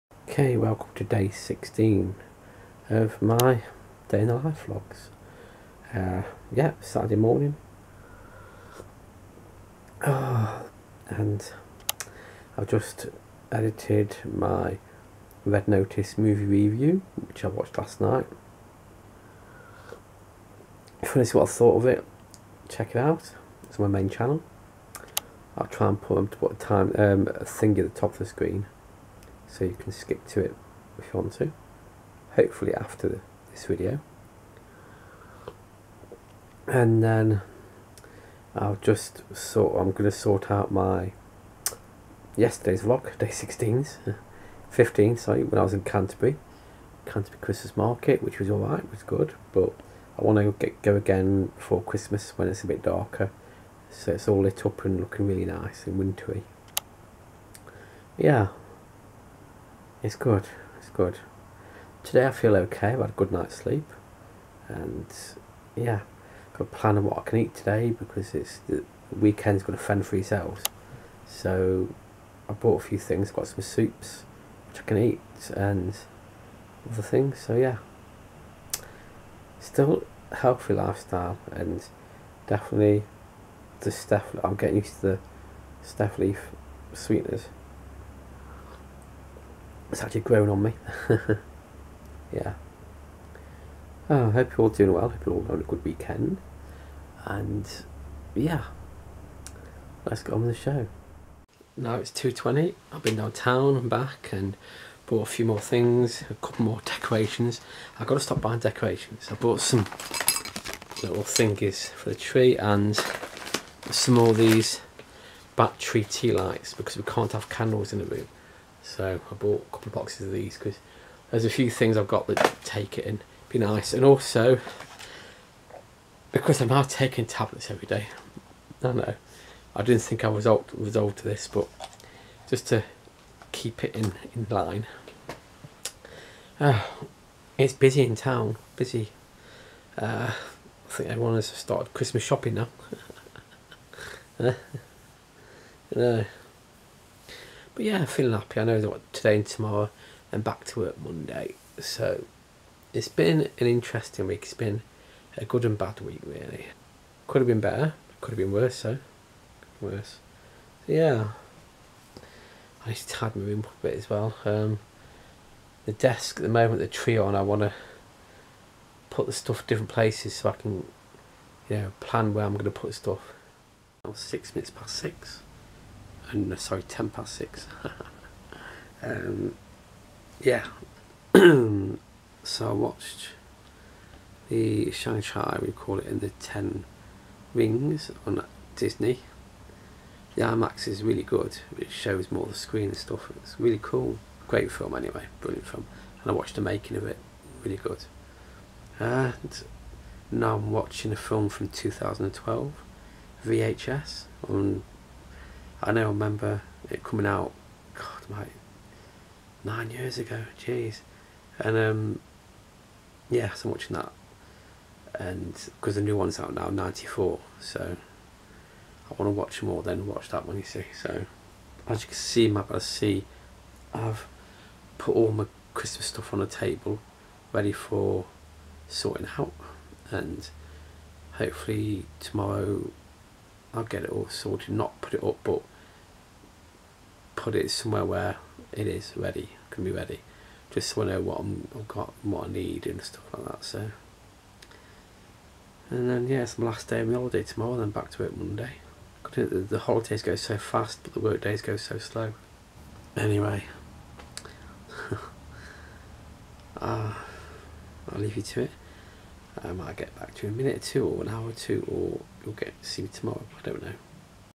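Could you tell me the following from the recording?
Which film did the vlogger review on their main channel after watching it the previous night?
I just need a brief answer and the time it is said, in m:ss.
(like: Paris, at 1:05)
Red Notice, at 0:15.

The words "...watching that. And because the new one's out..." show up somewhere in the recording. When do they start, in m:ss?
3:33.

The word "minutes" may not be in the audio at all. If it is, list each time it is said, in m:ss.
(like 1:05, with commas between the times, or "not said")
2:54, 4:20.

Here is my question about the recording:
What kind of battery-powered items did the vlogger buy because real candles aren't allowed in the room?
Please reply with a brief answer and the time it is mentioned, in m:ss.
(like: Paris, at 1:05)
tea lights, at 1:56.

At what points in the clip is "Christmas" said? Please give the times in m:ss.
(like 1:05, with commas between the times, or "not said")
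0:47, 0:51, 2:21, 3:45.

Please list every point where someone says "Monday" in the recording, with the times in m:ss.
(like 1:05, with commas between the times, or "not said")
2:30, 4:08.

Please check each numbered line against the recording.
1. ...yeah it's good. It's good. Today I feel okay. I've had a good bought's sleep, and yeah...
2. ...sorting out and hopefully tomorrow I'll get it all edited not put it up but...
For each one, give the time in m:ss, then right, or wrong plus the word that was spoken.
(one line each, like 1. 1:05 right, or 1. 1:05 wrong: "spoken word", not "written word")
1. 0:58 wrong: "night", not "bought"
2. 3:48 wrong: "sorted", not "edited".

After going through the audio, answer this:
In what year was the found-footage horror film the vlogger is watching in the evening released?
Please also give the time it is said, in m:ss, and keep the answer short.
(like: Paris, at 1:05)
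2012, at 3:21.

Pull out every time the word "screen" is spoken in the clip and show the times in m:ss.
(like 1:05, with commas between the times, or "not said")
0:28, 3:12.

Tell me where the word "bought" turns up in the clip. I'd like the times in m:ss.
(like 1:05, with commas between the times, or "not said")
1:12, 1:45, 1:49, 1:59.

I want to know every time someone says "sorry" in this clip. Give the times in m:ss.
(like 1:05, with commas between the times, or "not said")
0:45, 2:56.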